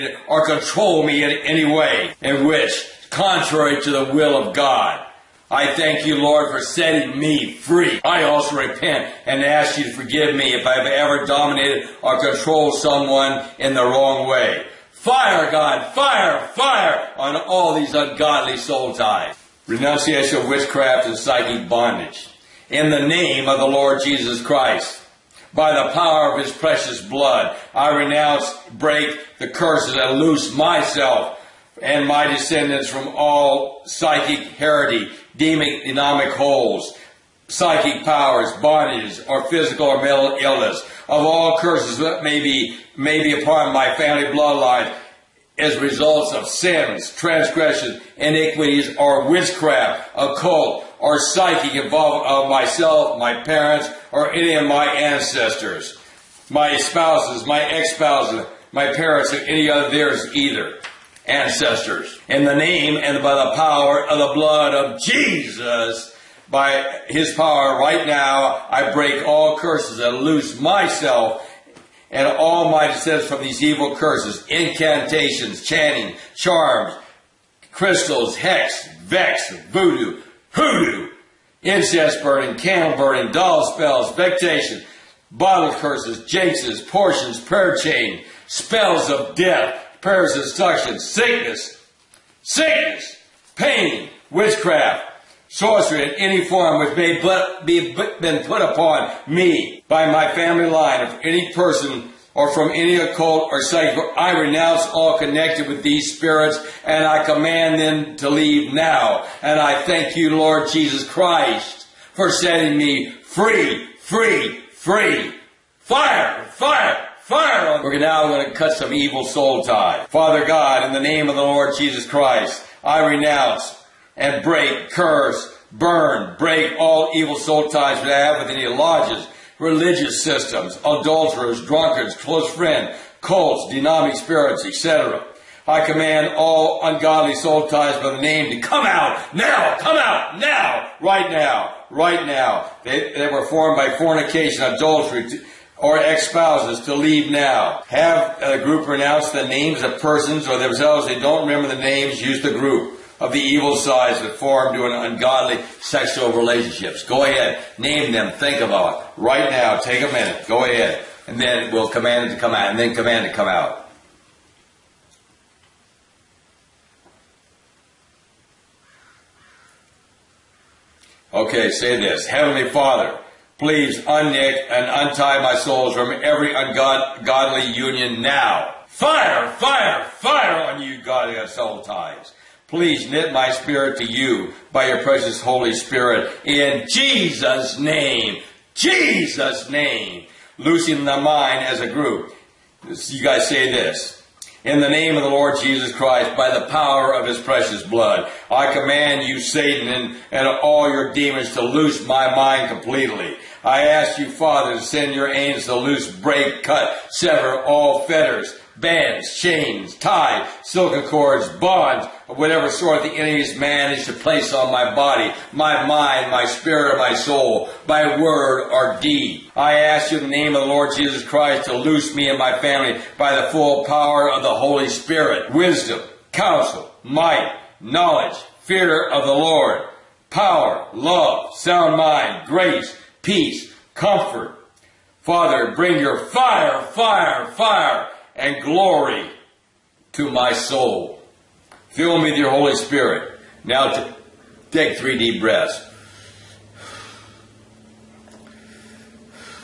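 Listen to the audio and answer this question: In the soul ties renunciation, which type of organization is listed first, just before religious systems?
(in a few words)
Lodges.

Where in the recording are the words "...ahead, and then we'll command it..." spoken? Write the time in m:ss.
2:40.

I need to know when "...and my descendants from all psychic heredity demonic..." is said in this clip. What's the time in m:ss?
0:31.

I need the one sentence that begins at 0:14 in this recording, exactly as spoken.
Fire, God, fire, fire on all these ungodly soul ties.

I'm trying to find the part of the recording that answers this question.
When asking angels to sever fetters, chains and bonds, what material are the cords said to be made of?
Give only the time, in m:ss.
3:30.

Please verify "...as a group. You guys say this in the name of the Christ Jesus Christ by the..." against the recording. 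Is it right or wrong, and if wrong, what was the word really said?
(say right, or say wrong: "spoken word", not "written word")
wrong: "Lord", not "Christ".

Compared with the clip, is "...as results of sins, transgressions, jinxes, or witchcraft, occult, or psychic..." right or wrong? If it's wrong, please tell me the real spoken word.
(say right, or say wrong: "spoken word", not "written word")
wrong: "iniquities", not "jinxes".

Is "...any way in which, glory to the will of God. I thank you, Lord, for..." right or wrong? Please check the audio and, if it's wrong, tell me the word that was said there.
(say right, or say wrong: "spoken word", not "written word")
wrong: "contrary", not "glory".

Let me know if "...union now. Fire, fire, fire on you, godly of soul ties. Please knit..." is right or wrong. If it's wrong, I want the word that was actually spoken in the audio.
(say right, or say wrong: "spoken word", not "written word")
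right.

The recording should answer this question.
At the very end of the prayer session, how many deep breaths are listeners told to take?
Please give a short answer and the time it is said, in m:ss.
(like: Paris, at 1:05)
3, at 4:04.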